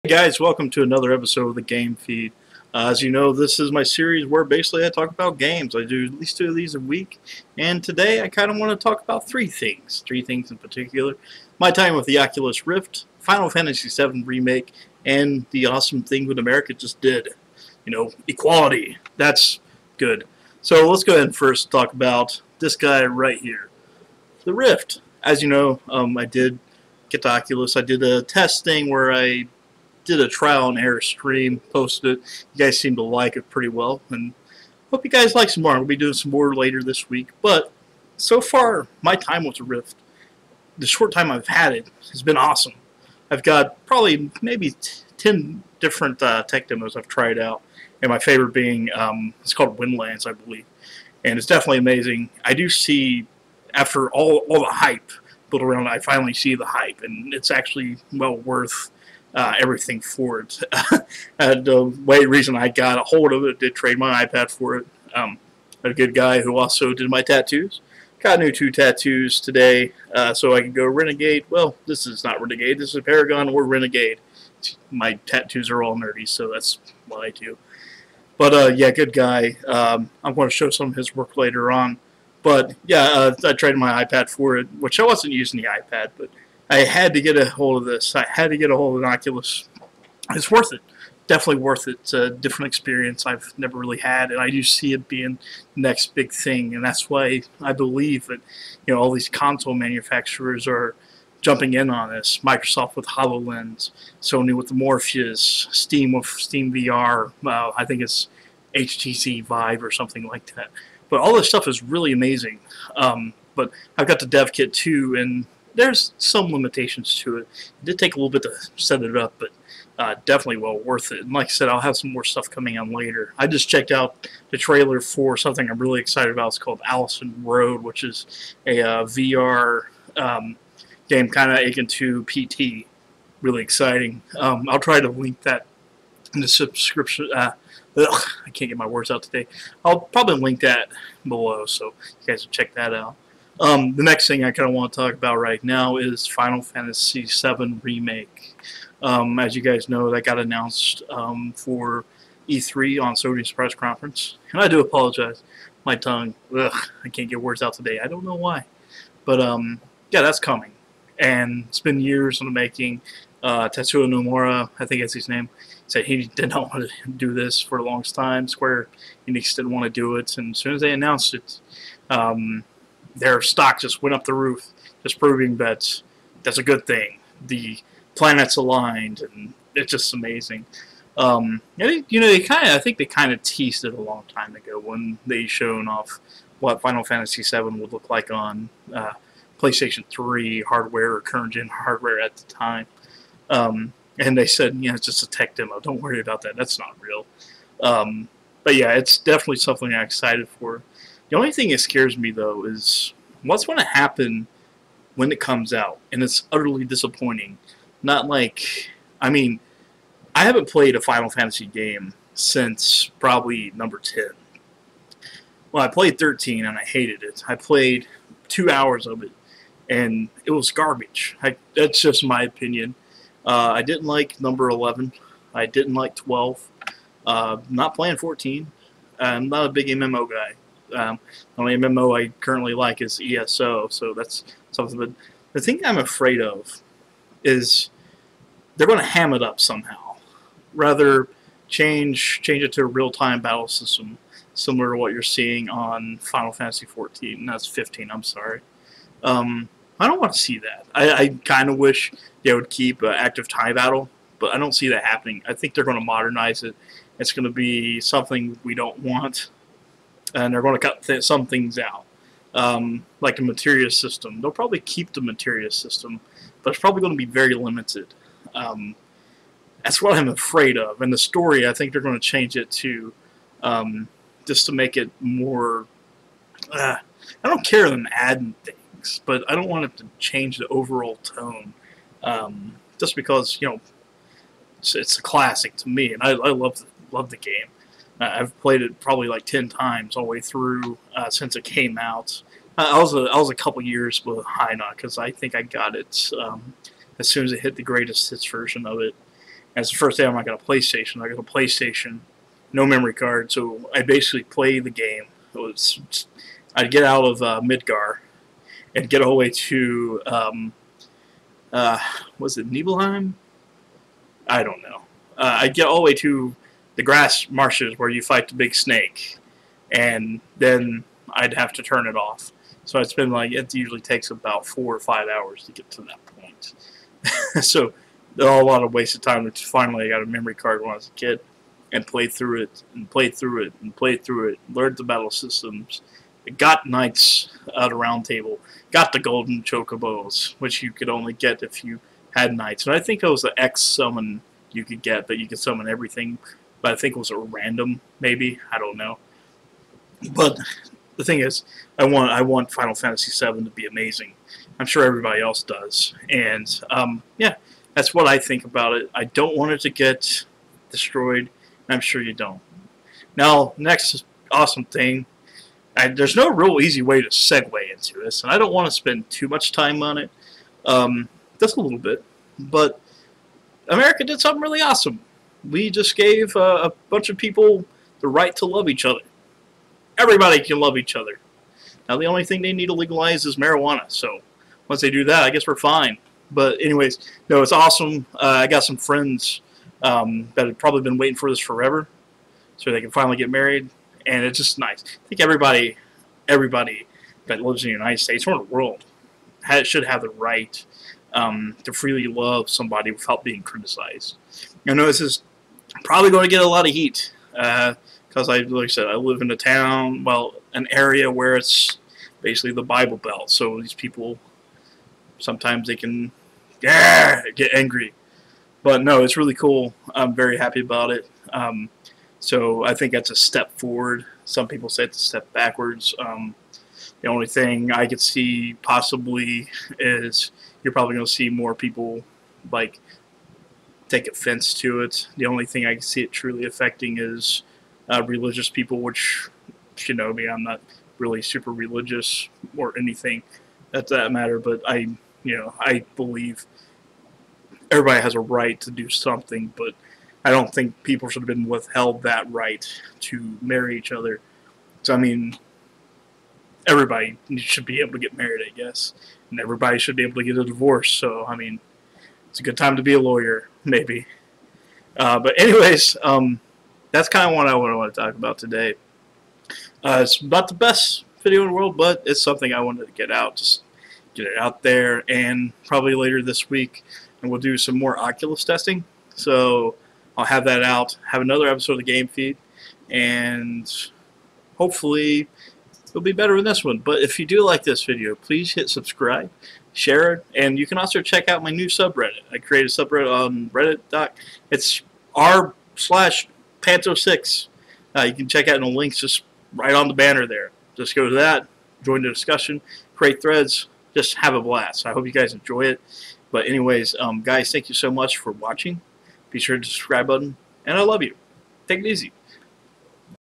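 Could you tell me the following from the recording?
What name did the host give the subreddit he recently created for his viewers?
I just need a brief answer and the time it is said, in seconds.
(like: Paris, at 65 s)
r/pants06, at 495 s.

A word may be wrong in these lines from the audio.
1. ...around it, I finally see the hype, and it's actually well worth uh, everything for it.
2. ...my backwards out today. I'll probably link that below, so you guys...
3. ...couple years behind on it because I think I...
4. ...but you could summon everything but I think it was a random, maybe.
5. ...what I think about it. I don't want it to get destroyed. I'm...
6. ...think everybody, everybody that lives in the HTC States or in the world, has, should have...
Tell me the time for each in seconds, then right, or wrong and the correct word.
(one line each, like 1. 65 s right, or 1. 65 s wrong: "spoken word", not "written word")
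1. 55 s right
2. 138 s wrong: "words", not "backwards"
3. 293 s right
4. 345 s right
5. 358 s right
6. 395 s wrong: "United", not "HTC".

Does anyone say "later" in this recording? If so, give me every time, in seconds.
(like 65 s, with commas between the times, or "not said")
36 s, 81 s, 122 s, 476 s.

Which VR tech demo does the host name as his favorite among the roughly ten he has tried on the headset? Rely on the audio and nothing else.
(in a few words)
Windlands.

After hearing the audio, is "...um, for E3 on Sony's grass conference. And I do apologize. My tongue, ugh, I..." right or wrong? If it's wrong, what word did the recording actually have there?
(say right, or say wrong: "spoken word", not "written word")
wrong: "press", not "grass".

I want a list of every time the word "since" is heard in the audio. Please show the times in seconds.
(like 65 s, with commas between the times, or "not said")
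212 s, 291 s.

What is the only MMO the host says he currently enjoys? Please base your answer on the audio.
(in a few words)
ESO.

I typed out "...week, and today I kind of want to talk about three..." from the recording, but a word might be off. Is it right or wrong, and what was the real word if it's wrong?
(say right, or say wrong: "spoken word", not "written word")
right.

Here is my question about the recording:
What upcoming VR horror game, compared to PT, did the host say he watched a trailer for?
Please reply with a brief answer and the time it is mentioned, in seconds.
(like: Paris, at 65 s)
Allison Road, at 126 s.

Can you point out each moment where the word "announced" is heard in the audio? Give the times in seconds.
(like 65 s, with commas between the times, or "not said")
150 s, 170 s.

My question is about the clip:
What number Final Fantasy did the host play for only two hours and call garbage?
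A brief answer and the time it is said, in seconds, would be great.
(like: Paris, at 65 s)
13, at 216 s.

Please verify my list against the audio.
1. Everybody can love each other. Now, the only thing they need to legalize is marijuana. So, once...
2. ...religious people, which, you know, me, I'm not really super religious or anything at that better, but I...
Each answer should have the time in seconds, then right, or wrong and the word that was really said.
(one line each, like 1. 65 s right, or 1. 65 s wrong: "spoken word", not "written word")
1. 380 s right
2. 438 s wrong: "matter", not "better".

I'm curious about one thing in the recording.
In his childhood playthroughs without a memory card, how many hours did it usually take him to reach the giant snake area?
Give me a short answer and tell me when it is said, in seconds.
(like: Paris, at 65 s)
4 or 5 hours, at 324 s.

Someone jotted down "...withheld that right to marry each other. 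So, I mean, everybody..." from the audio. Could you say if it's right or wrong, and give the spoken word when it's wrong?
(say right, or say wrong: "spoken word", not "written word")
right.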